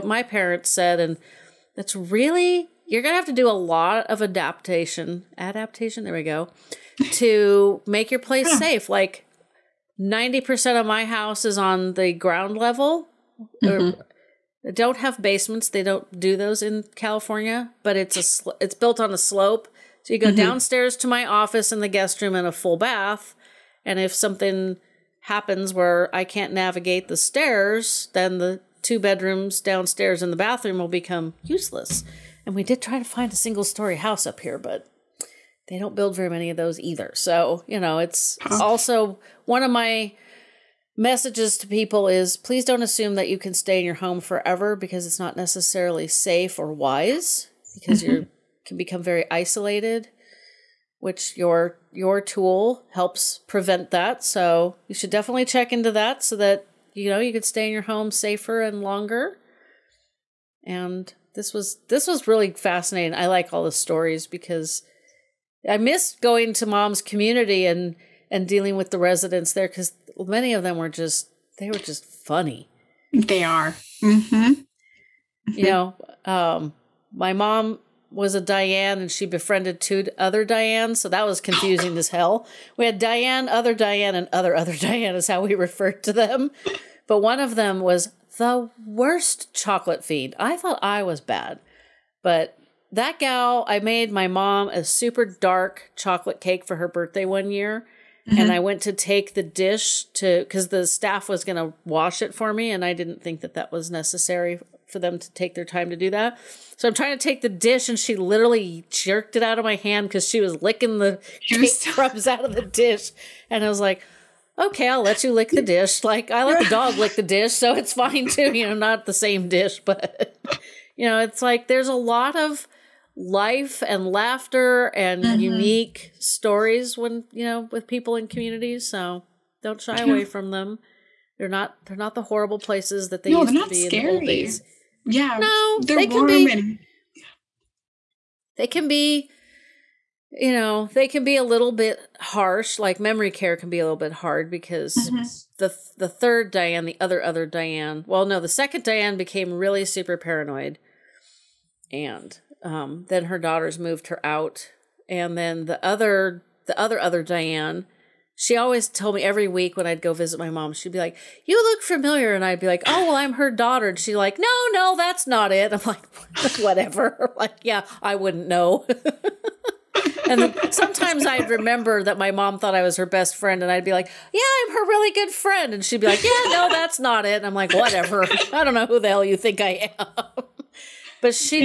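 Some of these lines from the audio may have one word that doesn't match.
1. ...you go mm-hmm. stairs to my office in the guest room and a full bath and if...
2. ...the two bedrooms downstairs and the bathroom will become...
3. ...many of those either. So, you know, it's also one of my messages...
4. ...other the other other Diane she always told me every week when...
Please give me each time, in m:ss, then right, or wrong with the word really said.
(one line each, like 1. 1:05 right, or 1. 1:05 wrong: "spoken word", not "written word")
1. 0:20 wrong: "downstairs", not "stairs"
2. 0:28 right
3. 0:36 right
4. 2:35 right.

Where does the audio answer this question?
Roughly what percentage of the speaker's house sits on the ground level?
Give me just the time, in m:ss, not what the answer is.
0:09.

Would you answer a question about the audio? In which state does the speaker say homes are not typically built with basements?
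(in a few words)
California.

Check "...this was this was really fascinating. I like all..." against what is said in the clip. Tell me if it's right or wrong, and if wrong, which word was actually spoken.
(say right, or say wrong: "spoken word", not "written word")
right.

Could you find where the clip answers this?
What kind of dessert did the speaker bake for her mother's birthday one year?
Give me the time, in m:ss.
1:34.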